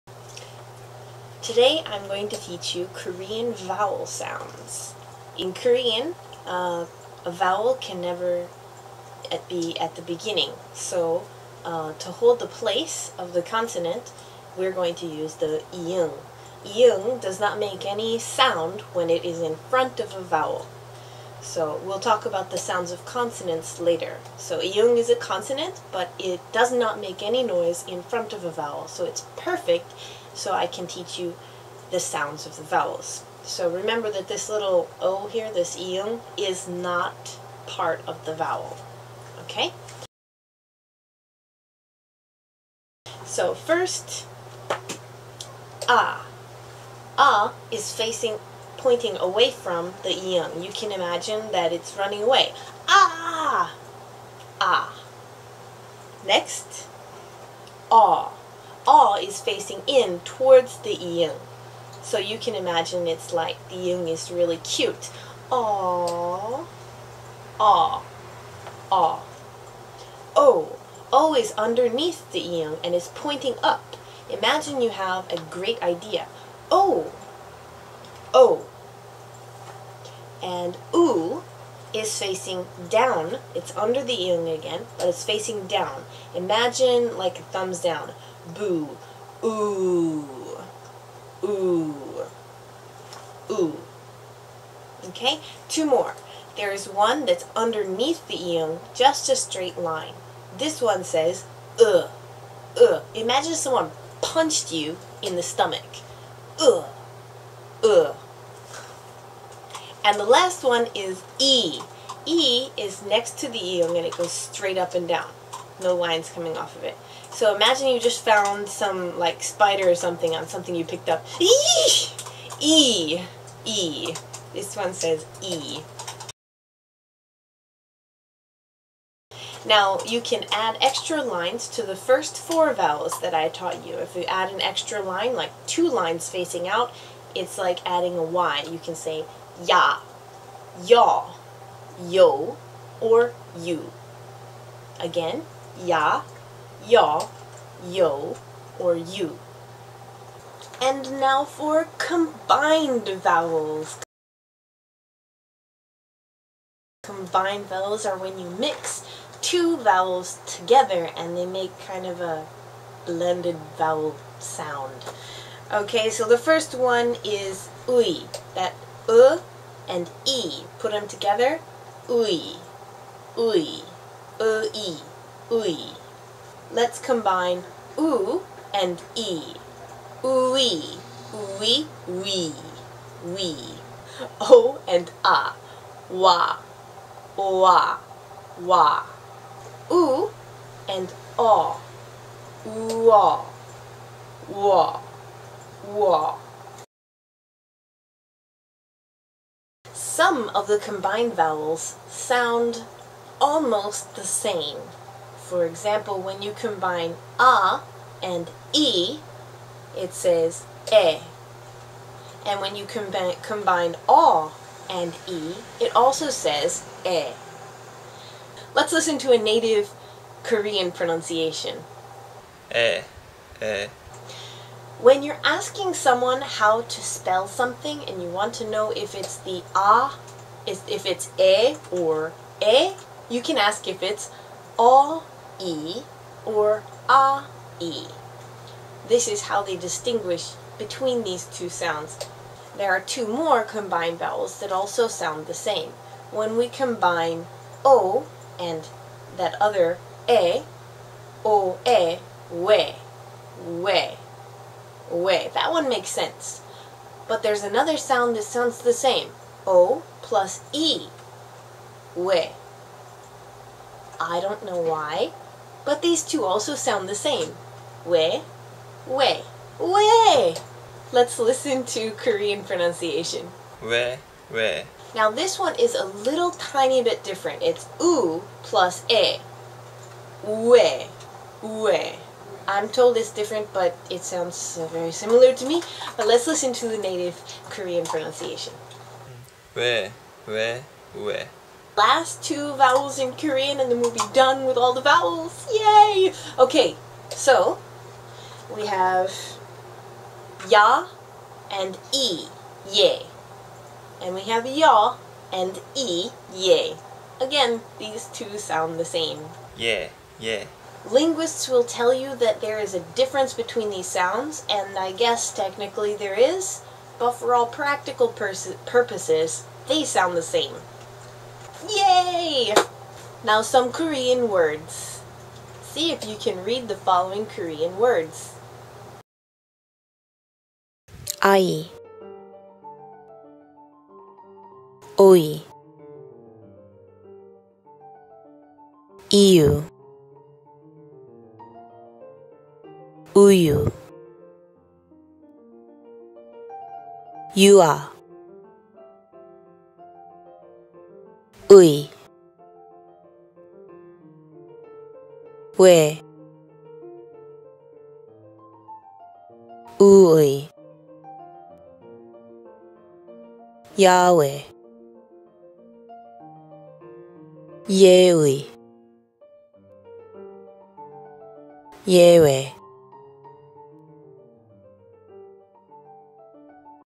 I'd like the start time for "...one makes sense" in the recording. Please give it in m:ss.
4:15.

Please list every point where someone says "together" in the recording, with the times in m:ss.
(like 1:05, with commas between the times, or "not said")
2:40, 2:51.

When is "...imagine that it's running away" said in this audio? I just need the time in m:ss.
0:50.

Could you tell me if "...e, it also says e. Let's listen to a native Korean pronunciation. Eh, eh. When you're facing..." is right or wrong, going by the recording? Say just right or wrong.
wrong.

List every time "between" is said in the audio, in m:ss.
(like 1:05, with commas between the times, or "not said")
4:00, 5:13.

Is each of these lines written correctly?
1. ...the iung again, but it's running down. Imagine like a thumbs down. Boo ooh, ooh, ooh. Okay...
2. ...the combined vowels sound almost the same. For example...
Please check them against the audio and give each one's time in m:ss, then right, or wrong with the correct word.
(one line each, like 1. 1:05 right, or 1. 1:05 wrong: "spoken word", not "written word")
1. 1:24 wrong: "facing", not "running"
2. 3:20 right.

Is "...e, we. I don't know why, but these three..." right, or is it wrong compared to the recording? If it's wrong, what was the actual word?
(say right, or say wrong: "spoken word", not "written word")
wrong: "two", not "three".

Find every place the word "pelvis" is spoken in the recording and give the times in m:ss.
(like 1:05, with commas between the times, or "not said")
not said.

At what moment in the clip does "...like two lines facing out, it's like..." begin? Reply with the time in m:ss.
2:15.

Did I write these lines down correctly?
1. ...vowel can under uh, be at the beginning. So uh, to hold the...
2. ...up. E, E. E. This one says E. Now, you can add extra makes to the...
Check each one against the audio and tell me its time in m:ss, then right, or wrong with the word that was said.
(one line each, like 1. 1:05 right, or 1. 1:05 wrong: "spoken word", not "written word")
1. 0:07 wrong: "never", not "under"
2. 2:01 wrong: "lines", not "makes".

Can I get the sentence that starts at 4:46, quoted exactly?
But let's listen to the native Korean pronunciation.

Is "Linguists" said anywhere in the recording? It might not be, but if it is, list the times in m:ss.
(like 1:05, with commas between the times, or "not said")
5:11.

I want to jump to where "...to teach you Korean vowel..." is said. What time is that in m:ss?
0:02.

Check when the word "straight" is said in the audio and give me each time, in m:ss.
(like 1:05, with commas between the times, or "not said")
1:39, 1:54.